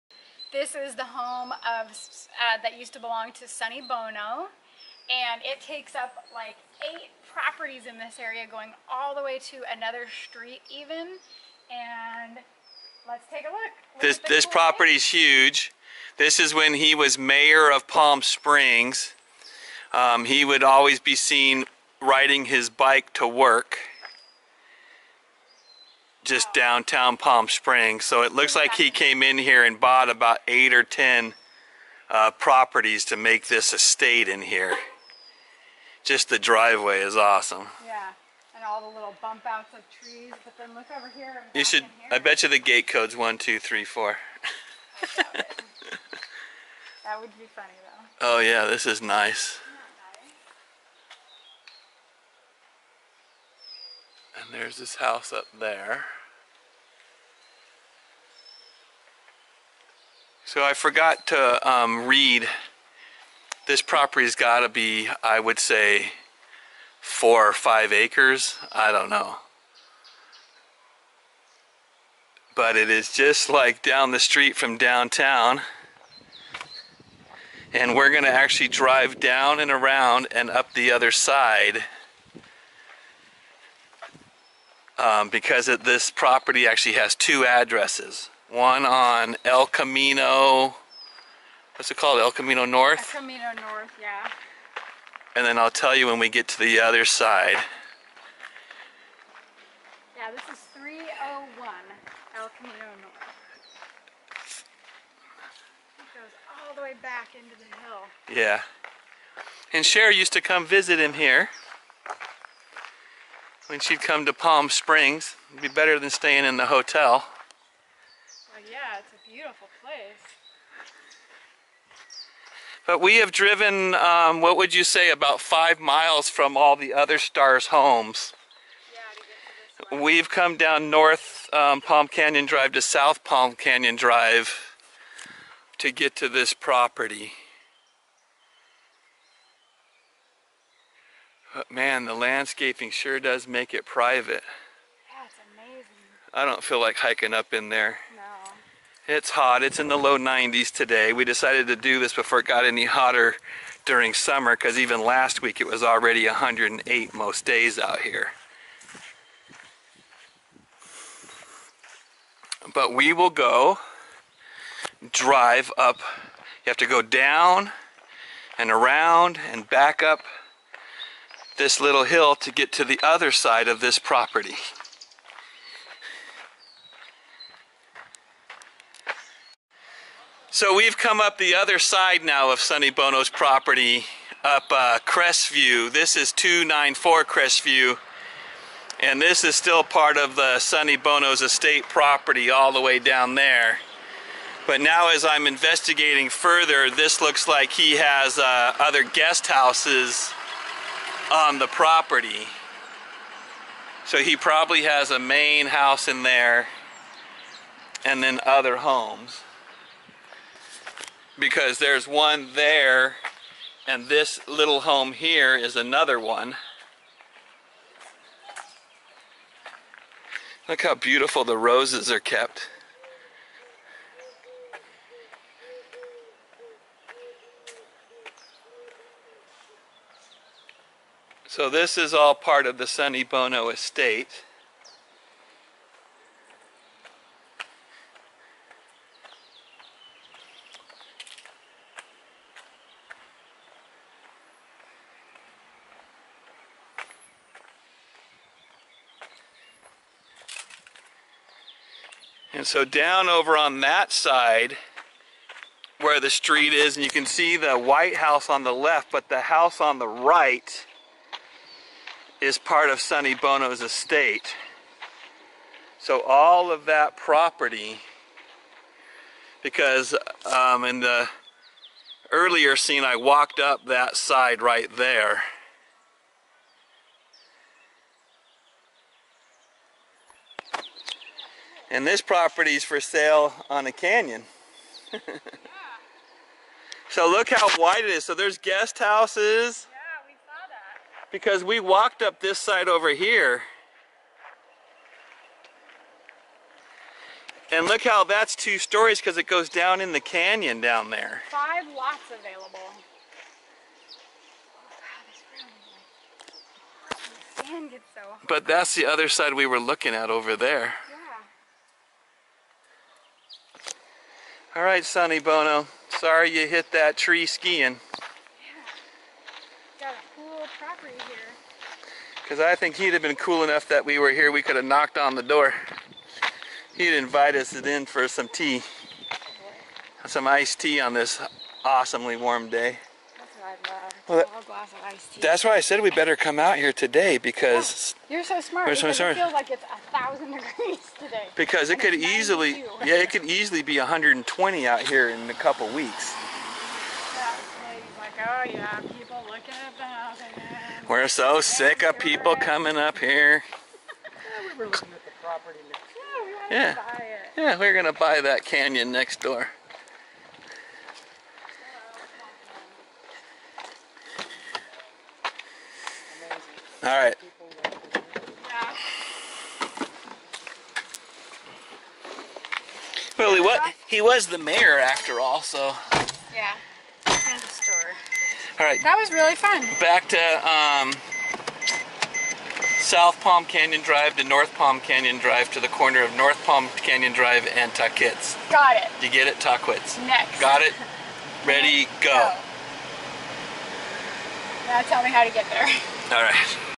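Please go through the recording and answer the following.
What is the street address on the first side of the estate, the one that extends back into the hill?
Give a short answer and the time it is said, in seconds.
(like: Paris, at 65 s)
301 El Camino North, at 100 s.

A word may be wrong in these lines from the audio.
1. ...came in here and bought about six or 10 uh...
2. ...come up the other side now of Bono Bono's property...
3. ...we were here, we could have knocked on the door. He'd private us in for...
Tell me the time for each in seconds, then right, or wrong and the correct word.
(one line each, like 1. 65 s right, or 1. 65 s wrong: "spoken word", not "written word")
1. 28 s wrong: "eight", not "six"
2. 180 s wrong: "Sonny", not "Bono"
3. 324 s wrong: "invite", not "private".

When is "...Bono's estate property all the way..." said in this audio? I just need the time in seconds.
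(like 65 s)
190 s.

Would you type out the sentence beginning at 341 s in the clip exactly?
Because it and could easily, yeah, it could easily be 120 out here in a couple weeks.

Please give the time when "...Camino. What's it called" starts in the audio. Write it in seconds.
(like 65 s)
89 s.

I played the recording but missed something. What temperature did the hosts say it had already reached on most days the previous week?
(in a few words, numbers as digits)
108.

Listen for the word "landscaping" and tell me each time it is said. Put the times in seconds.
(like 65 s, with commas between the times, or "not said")
142 s.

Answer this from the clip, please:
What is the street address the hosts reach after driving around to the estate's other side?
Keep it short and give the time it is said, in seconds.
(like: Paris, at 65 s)
294 Crestview, at 186 s.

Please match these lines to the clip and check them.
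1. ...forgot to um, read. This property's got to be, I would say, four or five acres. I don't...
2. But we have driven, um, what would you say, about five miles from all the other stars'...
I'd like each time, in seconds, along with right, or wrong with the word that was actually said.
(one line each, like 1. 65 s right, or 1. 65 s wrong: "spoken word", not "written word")
1. 60 s right
2. 122 s right.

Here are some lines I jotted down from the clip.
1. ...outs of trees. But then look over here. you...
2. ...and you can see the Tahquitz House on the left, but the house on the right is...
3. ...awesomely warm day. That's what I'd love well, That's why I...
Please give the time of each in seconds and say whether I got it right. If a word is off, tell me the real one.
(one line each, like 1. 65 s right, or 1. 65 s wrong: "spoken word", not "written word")
1. 39 s right
2. 256 s wrong: "White", not "Tahquitz"
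3. 331 s right.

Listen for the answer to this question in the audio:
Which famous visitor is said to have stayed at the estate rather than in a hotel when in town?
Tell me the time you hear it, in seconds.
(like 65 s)
109 s.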